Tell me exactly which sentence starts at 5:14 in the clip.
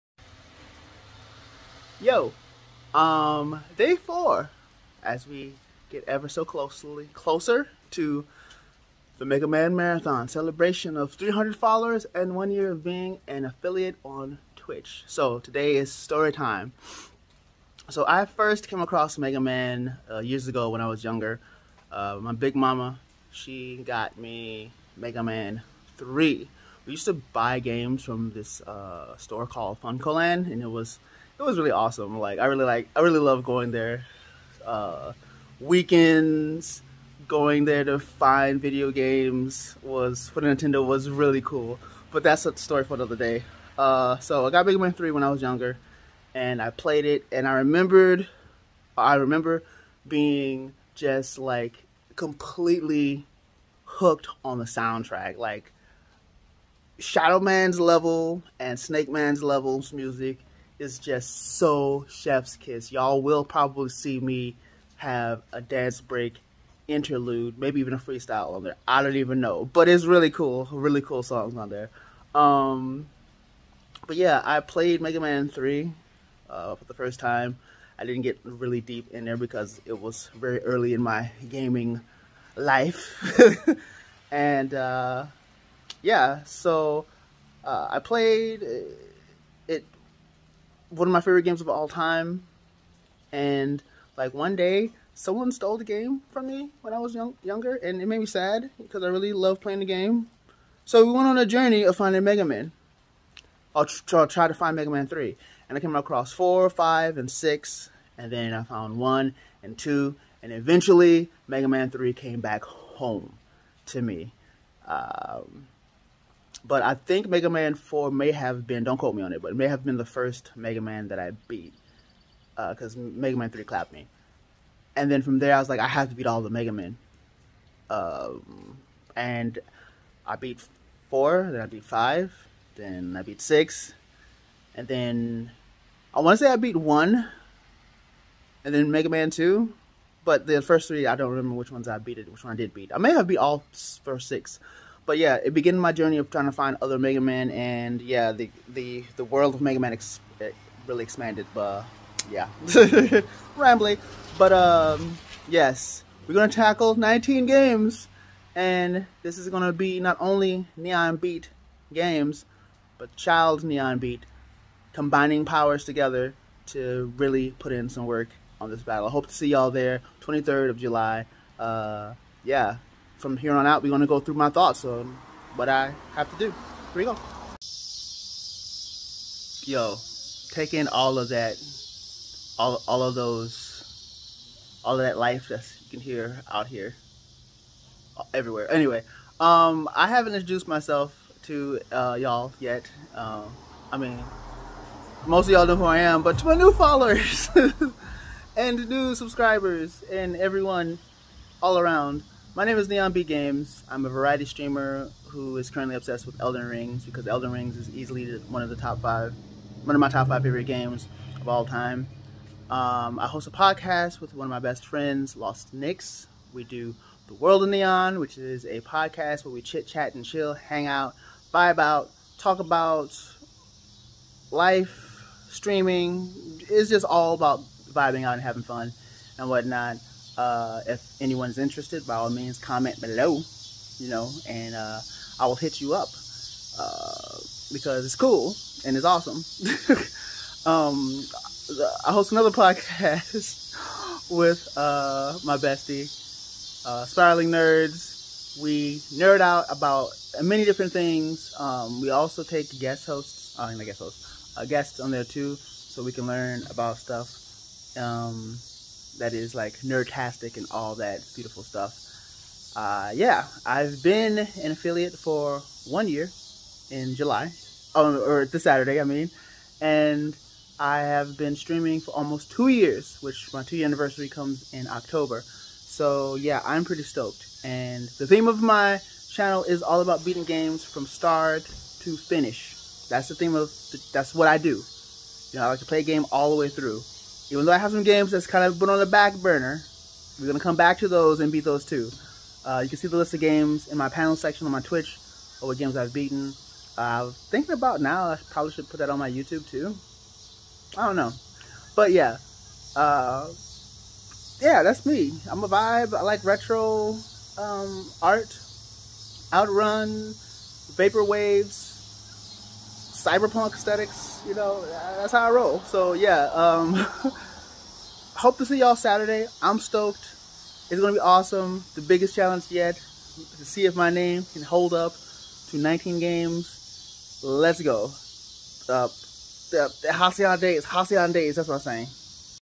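You know, that's how I roll.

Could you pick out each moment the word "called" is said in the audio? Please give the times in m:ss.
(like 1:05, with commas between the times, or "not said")
0:29.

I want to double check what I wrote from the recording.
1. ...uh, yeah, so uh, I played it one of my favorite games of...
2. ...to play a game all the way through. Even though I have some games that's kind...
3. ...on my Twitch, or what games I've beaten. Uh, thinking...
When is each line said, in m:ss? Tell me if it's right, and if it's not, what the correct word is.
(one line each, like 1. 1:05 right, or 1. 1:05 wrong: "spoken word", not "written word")
1. 1:24 right
2. 4:45 right
3. 4:54 right.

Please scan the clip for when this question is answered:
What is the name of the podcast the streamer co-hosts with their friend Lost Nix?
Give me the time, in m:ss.
3:37.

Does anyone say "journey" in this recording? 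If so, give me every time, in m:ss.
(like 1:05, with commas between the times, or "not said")
1:41, 2:25.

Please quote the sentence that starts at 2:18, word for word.
And then Mega Man 2 but the first three, I don't remember which ones I beat it, which one I did beat.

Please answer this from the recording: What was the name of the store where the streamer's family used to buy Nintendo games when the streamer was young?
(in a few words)
FuncoLand.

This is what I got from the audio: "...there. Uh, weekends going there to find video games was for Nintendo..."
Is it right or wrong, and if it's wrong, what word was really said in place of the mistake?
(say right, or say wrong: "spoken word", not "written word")
right.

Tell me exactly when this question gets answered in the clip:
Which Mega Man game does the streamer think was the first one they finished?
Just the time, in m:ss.
1:57.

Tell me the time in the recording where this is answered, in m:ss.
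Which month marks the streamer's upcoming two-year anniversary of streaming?
4:34.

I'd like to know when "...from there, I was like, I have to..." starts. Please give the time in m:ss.
2:05.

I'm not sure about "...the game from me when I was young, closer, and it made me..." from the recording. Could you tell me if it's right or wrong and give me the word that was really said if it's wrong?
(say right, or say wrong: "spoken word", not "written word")
wrong: "younger", not "closer".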